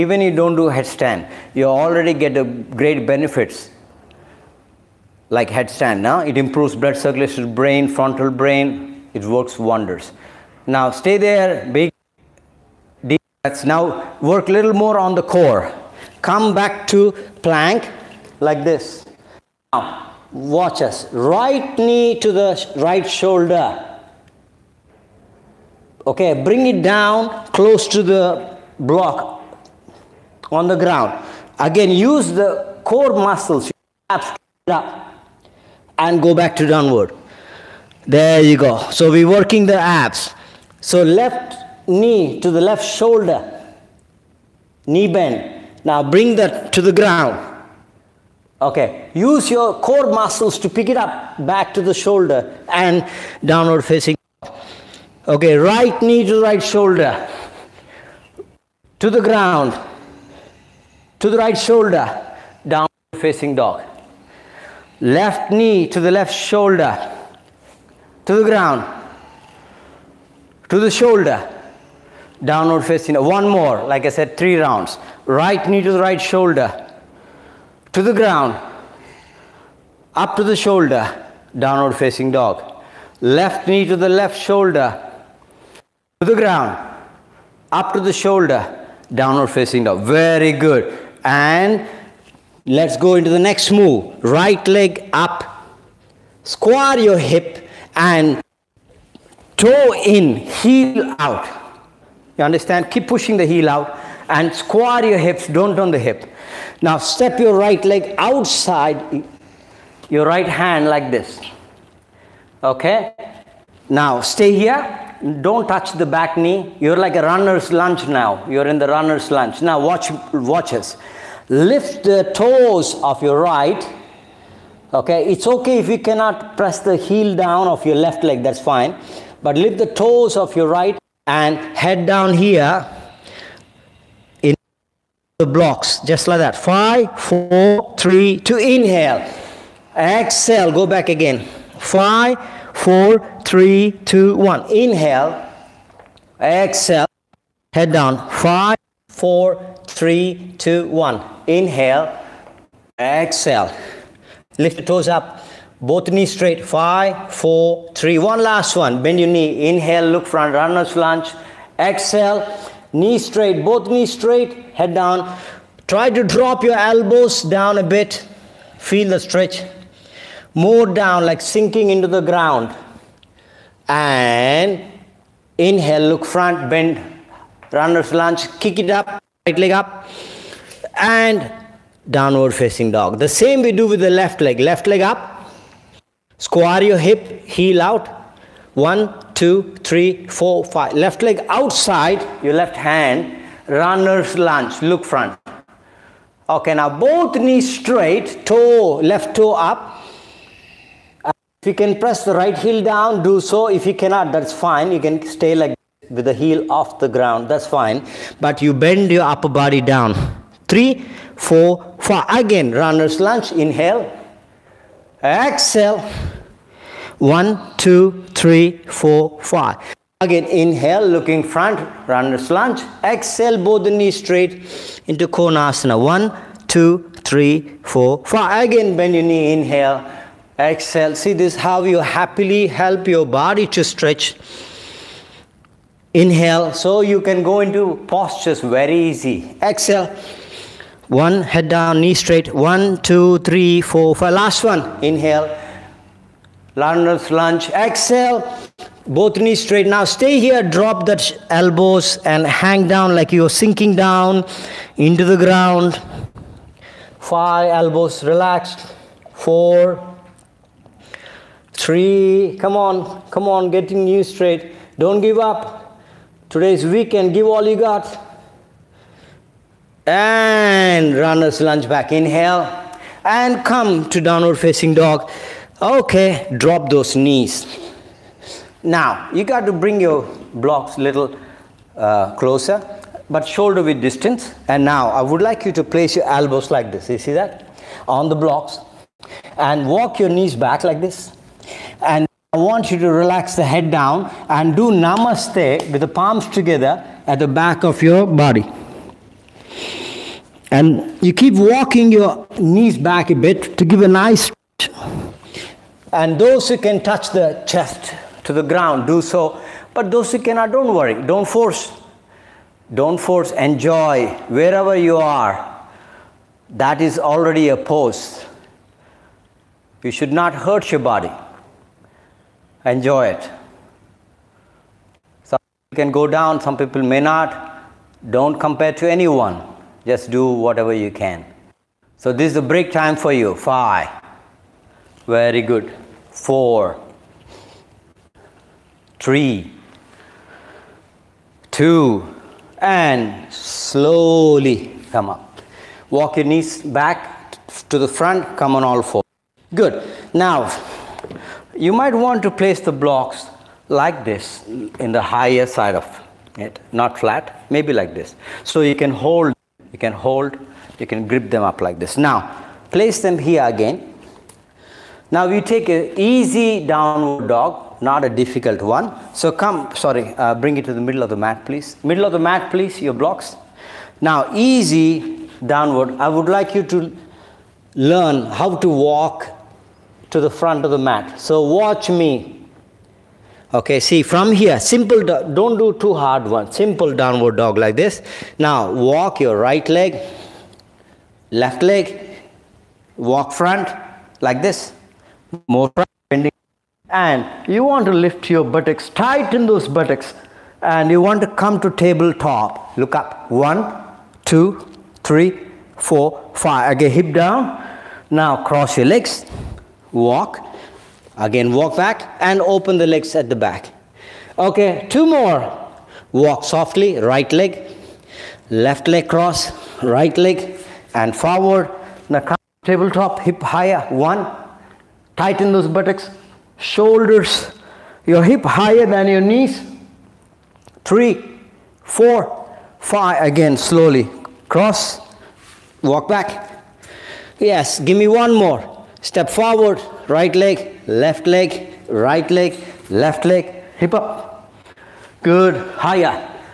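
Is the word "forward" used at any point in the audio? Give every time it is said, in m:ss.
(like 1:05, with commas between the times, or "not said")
7:01, 7:19.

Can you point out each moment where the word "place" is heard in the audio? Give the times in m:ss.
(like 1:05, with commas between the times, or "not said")
4:45, 5:52, 6:02.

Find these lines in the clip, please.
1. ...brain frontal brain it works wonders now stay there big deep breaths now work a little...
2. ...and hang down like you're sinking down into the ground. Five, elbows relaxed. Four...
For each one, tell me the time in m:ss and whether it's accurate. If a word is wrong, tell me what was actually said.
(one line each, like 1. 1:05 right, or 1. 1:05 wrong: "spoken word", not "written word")
1. 0:07 right
2. 4:12 right.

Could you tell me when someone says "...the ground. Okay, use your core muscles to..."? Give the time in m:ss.
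0:46.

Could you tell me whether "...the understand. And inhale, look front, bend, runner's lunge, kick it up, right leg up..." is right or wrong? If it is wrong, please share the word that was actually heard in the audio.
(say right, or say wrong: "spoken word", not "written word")
wrong: "ground", not "understand".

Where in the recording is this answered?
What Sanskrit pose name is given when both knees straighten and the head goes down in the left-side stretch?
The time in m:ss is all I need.
3:45.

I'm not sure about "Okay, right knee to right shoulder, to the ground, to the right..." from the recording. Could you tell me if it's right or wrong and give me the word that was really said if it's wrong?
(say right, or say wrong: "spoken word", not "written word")
right.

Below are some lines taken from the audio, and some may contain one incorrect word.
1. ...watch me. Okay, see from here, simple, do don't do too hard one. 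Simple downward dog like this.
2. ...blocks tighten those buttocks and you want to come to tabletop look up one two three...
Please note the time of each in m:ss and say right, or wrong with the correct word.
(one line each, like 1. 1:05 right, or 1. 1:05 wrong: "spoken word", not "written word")
1. 6:21 right
2. 6:38 wrong: "buttocks", not "blocks".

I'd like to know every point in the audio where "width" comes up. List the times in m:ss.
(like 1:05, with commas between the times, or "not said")
4:43.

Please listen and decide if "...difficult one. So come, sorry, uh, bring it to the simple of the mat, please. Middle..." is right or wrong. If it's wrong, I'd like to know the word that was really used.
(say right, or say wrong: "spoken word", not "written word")
wrong: "middle", not "simple".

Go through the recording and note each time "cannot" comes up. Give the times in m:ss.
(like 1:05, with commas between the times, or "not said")
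2:05, 3:23, 5:10.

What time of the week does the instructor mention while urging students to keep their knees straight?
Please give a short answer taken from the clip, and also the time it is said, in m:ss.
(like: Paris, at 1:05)
Weekend, at 4:26.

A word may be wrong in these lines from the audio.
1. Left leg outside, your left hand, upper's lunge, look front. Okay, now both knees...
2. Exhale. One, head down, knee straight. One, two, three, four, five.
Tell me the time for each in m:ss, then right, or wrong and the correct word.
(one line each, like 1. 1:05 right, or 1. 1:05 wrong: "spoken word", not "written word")
1. 3:10 wrong: "runner", not "upper"
2. 3:59 right.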